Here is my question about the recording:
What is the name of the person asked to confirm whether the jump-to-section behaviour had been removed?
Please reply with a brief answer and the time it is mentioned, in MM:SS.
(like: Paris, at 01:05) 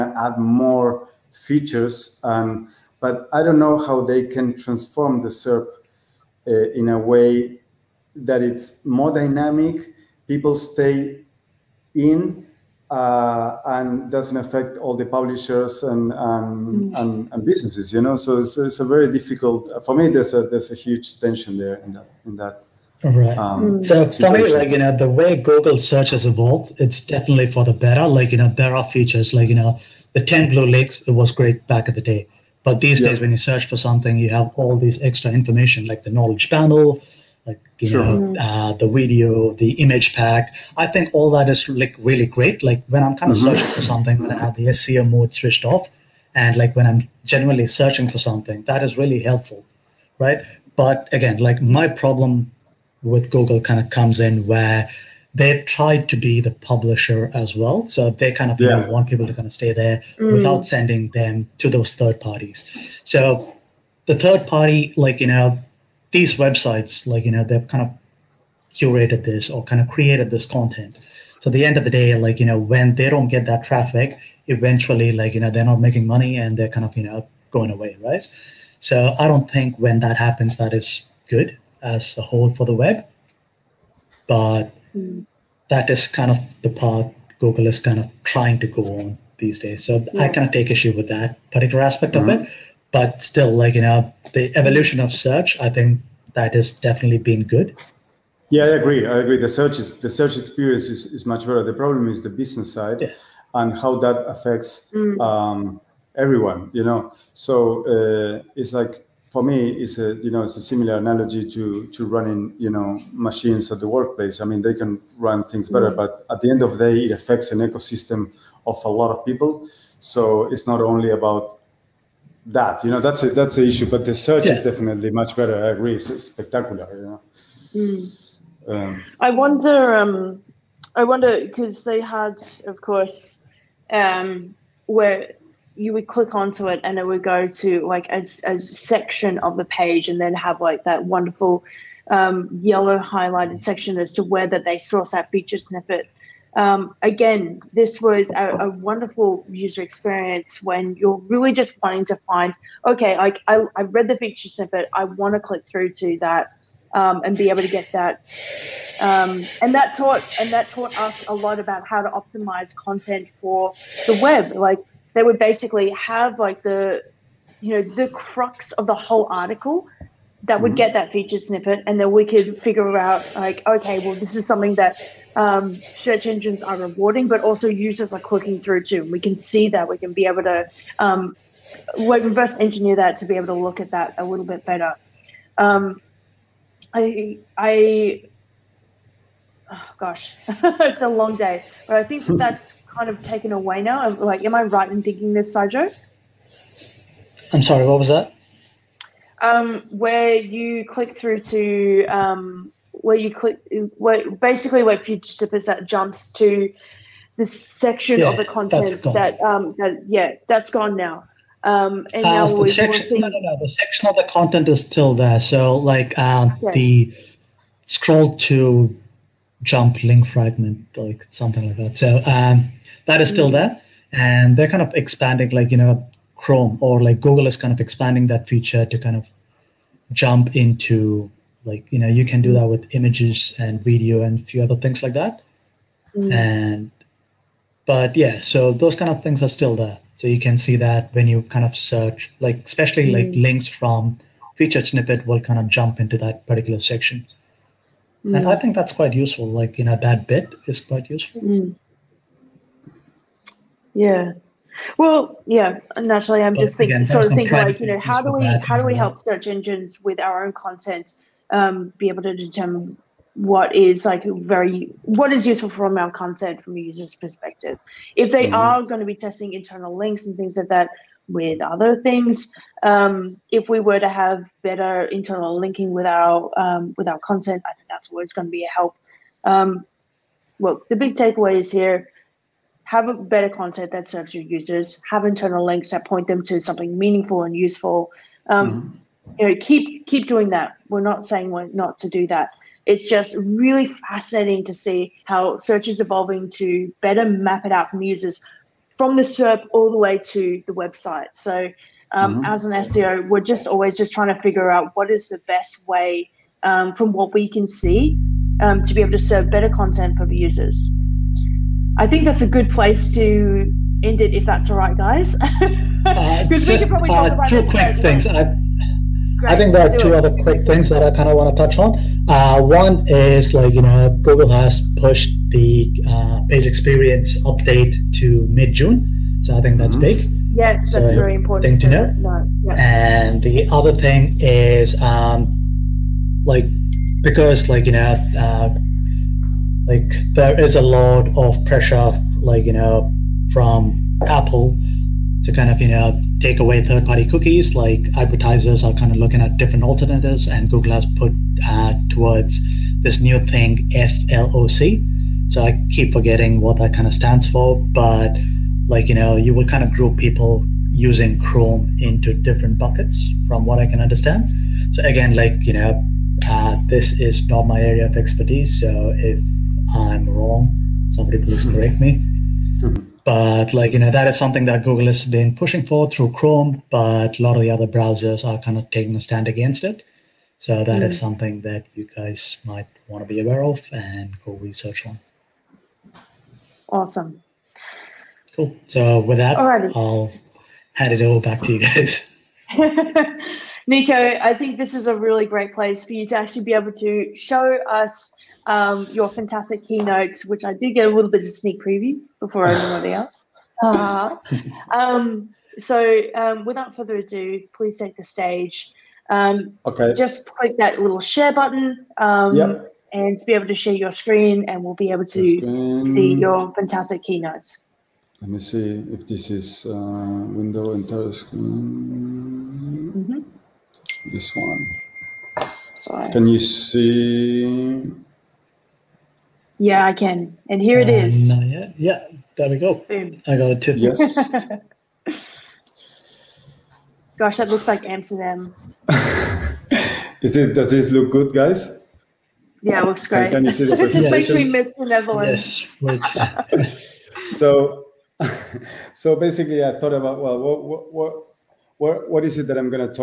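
Saijo, at 03:15.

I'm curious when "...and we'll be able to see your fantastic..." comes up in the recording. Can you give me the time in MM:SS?
06:54.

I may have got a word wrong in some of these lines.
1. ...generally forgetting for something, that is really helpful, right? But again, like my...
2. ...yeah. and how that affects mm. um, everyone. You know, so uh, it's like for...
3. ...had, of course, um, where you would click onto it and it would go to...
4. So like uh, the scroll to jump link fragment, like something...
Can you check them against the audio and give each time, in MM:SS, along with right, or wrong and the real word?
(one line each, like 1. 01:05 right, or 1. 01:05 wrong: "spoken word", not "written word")
1. 00:47 wrong: "searching", not "forgetting"
2. 01:43 right
3. 02:12 right
4. 03:35 right.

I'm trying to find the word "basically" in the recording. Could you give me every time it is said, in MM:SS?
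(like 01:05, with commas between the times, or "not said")
02:45, 03:24, 07:29.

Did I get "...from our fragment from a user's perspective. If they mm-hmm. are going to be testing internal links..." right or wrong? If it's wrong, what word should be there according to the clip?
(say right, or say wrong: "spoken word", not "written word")
wrong: "content", not "fragment".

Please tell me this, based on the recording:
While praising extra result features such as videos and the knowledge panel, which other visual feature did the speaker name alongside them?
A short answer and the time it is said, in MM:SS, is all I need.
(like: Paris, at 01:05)
image pack, at 00:39.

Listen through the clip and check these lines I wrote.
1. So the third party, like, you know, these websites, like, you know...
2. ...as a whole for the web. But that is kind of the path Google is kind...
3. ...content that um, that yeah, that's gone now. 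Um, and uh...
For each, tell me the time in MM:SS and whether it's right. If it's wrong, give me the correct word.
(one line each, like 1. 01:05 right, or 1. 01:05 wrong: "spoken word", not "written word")
1. 01:03 right
2. 01:21 right
3. 03:28 right.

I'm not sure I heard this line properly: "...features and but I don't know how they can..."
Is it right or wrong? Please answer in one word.
right.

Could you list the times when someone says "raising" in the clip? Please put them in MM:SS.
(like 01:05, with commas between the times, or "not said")
not said.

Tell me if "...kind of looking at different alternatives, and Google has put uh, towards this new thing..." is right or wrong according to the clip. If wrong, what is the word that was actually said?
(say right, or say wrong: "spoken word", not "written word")
right.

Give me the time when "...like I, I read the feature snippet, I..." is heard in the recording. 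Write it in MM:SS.
02:33.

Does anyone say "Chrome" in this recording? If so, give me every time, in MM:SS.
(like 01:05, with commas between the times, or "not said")
03:46, 06:01, 06:16.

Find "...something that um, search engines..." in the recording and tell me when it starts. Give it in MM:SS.
02:54.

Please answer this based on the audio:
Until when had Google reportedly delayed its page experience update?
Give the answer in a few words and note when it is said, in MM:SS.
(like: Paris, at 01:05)
mid June, at 05:28.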